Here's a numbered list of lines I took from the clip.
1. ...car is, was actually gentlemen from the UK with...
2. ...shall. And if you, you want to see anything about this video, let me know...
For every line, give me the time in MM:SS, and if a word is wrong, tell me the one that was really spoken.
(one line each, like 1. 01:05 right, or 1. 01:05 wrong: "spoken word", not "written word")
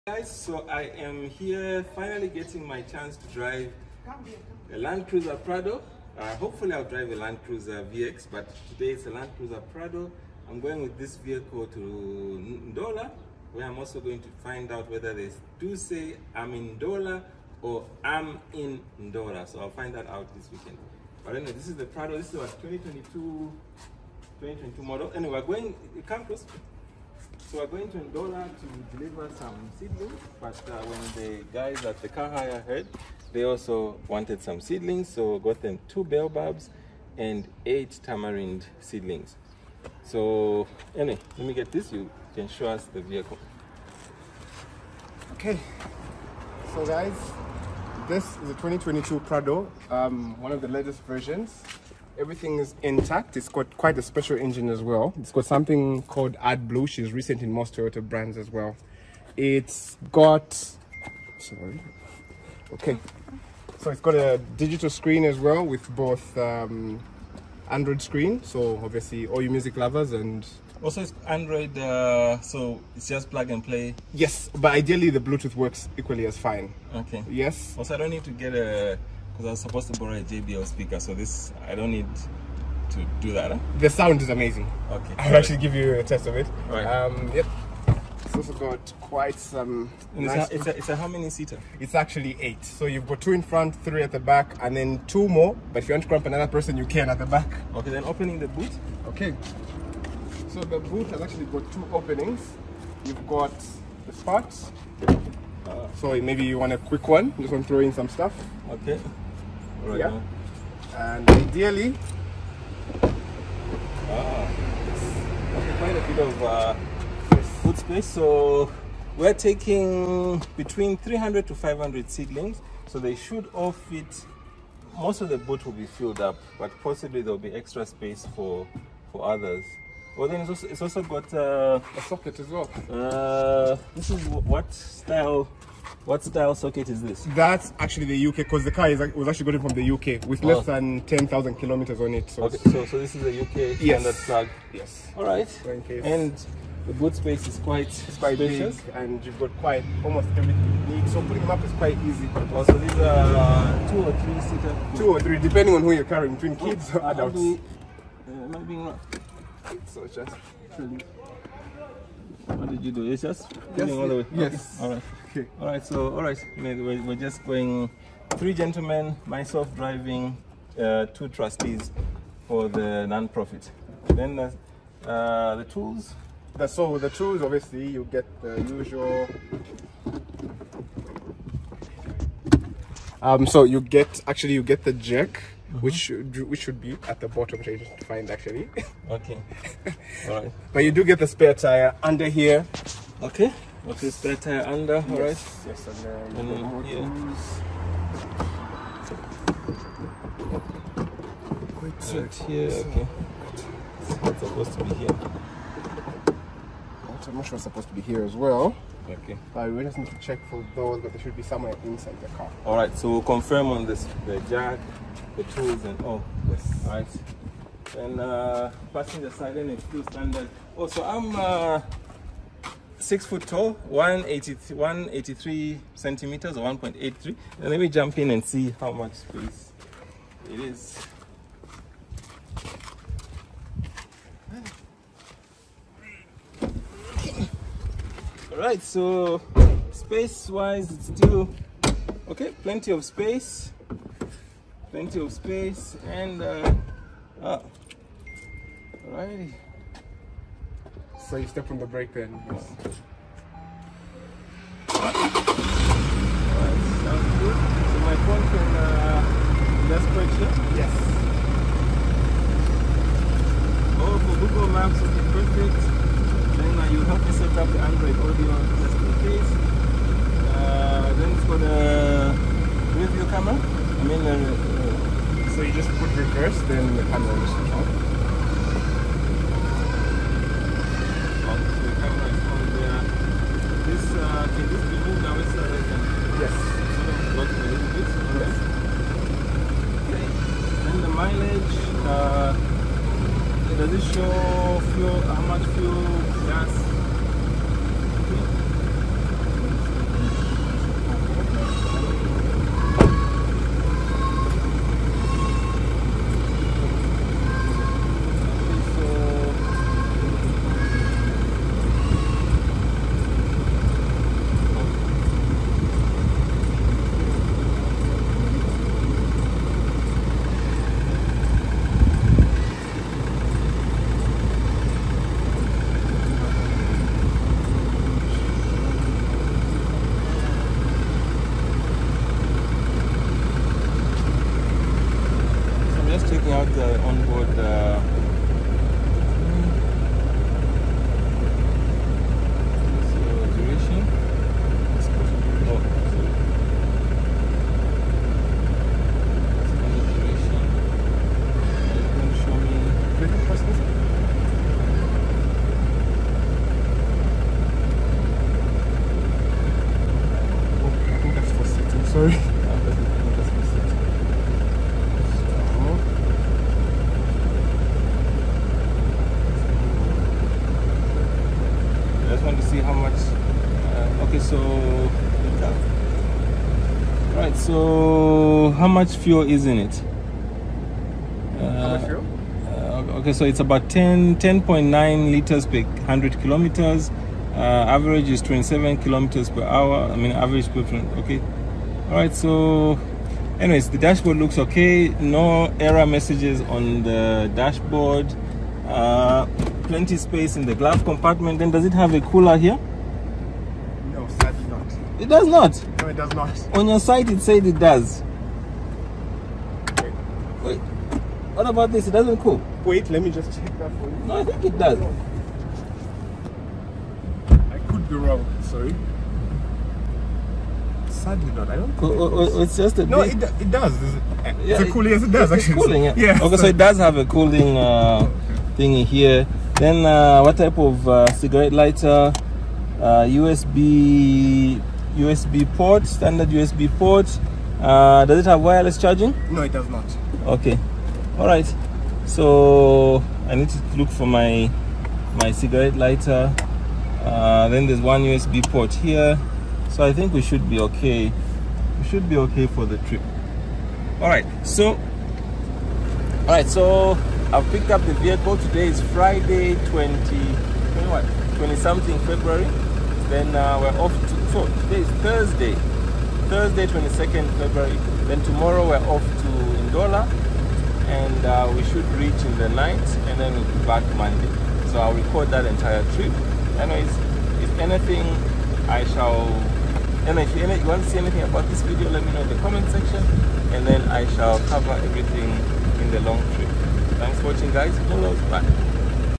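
1. 02:18 wrong: "gotten", not "gentlemen"
2. 07:59 right.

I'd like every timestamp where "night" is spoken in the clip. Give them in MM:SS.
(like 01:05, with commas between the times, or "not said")
07:52.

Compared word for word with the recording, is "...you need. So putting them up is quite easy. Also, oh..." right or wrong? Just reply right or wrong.
right.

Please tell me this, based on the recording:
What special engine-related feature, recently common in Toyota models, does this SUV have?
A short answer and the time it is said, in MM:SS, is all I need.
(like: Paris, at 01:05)
AdBlue, at 00:56.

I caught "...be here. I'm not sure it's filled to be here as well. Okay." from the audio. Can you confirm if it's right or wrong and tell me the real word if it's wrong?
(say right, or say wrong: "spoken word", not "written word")
wrong: "supposed", not "filled".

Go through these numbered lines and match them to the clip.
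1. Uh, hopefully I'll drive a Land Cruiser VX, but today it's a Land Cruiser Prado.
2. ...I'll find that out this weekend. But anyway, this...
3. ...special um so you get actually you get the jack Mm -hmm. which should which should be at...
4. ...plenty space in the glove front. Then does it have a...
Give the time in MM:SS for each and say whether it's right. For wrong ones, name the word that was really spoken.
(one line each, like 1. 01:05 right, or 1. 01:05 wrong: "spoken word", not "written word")
1. 00:06 right
2. 00:19 right
3. 02:58 wrong: "usual", not "special"
4. 06:39 wrong: "compartment", not "front".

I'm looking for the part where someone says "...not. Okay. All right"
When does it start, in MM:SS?
07:19.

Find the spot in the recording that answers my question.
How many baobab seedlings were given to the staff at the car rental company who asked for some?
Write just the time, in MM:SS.
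00:35.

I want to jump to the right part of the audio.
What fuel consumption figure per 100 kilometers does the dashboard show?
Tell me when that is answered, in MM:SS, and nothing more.
06:24.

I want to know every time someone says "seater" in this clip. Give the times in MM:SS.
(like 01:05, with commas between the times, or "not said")
01:31, 02:34.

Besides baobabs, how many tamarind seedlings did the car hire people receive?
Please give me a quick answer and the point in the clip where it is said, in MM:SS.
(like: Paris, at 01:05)
8, at 00:37.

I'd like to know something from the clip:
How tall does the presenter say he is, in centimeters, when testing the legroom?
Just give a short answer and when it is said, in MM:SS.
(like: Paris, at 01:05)
183 centimeters, at 03:43.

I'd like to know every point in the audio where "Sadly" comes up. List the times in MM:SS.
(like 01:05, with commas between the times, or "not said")
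07:01.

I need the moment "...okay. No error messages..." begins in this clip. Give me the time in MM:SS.
06:34.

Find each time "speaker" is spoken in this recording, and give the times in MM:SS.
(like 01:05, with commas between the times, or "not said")
01:20.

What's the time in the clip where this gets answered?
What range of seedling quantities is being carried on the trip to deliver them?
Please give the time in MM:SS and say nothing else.
02:00.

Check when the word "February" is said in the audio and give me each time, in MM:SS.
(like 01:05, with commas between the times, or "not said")
07:42, 07:47.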